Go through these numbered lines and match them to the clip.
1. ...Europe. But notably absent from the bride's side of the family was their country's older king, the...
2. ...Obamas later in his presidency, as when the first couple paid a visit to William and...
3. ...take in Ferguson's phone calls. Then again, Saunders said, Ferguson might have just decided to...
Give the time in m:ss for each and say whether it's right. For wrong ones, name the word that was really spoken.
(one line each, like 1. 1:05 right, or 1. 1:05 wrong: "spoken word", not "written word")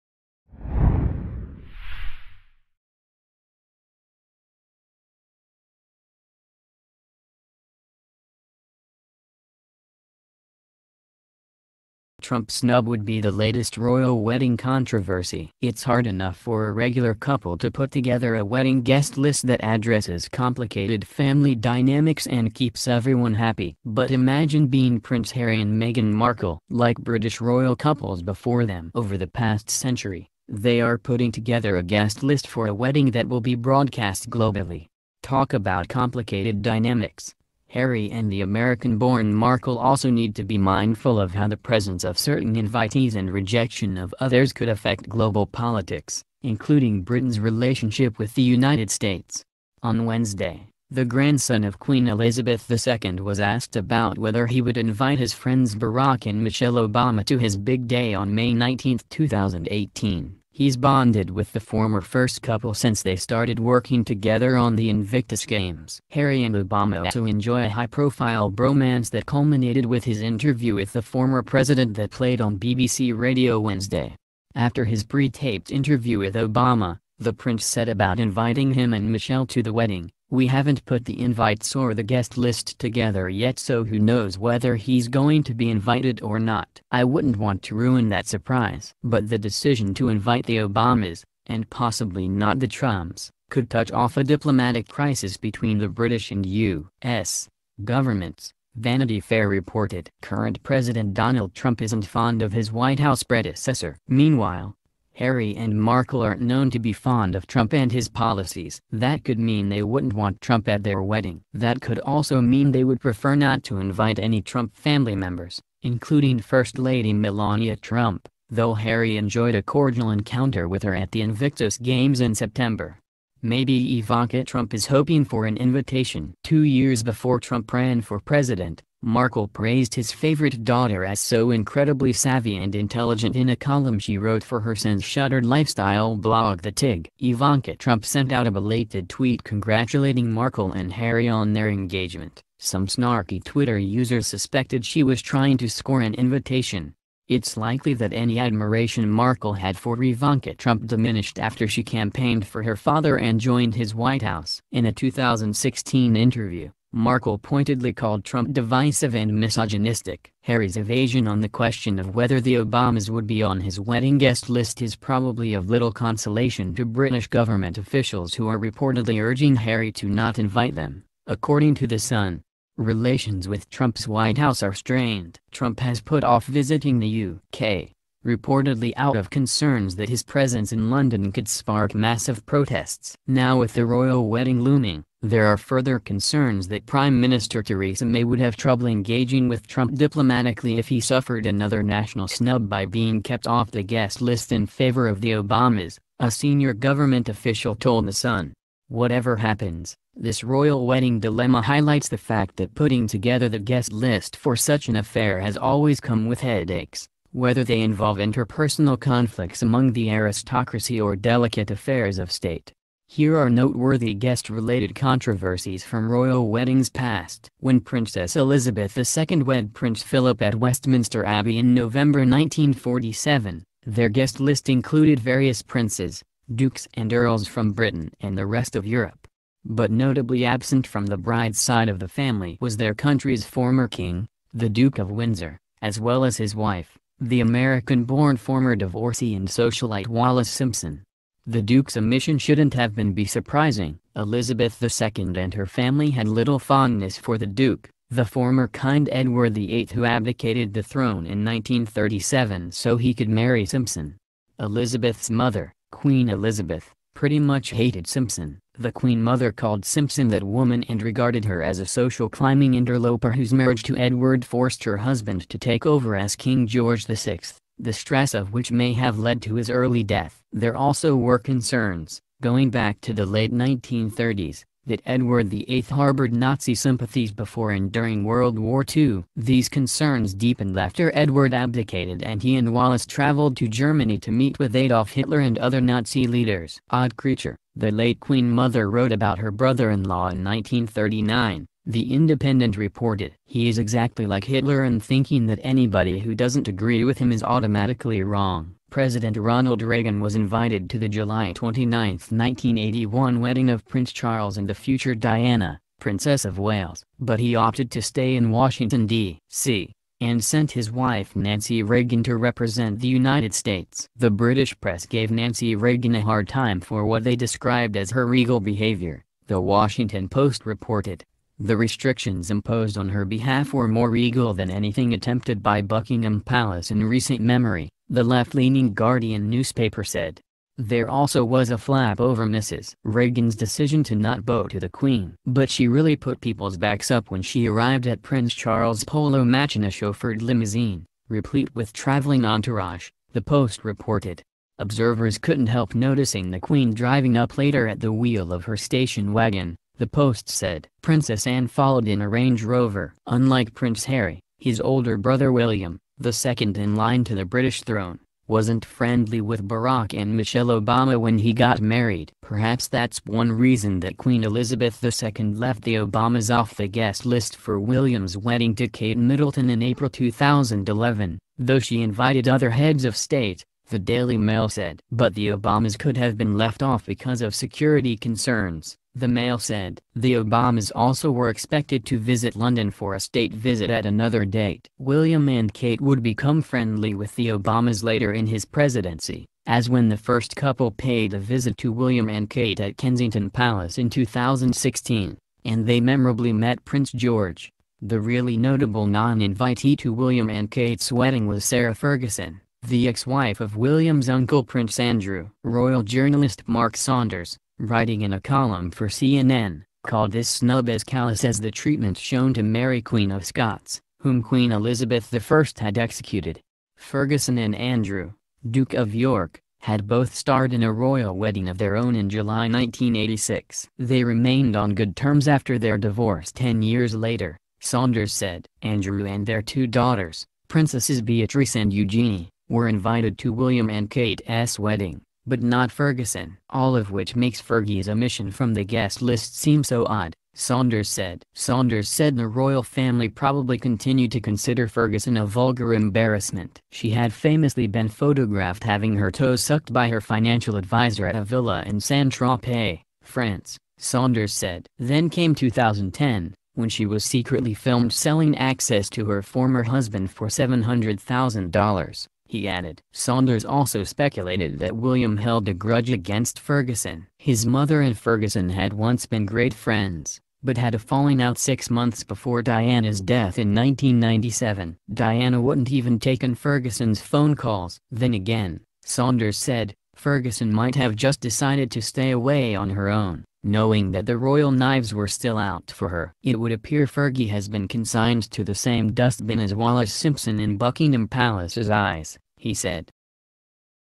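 1. 3:48 wrong: "former", not "older"
2. 6:27 right
3. 7:56 right.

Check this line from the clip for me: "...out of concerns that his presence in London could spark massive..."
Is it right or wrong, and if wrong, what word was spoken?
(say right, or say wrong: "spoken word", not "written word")
right.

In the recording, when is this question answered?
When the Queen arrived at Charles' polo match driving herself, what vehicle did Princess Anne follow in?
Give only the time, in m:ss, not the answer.
5:52.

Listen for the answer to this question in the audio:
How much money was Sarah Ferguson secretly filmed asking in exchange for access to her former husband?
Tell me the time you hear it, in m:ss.
7:40.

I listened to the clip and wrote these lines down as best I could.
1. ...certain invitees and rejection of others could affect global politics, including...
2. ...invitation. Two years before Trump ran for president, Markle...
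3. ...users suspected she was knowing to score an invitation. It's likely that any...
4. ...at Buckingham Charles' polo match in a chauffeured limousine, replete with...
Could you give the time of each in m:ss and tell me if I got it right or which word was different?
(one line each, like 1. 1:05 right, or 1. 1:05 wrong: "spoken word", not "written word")
1. 0:42 right
2. 2:05 right
3. 2:23 wrong: "trying", not "knowing"
4. 5:38 wrong: "Prince", not "Buckingham".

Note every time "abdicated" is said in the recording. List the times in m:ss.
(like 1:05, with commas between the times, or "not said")
4:10, 4:41.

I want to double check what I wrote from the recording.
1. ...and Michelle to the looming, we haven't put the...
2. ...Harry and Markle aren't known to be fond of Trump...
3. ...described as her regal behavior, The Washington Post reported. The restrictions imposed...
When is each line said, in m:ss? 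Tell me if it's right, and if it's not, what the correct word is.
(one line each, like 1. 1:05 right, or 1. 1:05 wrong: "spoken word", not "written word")
1. 1:18 wrong: "wedding", not "looming"
2. 1:45 right
3. 5:17 right.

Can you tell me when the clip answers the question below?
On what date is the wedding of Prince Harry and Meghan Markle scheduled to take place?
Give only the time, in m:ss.
0:58.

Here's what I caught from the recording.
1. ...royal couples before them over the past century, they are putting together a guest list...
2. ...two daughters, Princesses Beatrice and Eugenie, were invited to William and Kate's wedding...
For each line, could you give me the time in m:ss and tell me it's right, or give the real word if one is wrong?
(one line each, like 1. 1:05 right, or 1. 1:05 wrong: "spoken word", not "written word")
1. 0:27 right
2. 7:09 right.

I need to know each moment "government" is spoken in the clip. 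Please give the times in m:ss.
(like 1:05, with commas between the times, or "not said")
1:37, 2:47, 3:16.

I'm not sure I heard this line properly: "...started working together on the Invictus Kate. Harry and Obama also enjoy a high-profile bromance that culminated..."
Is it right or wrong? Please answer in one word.
wrong.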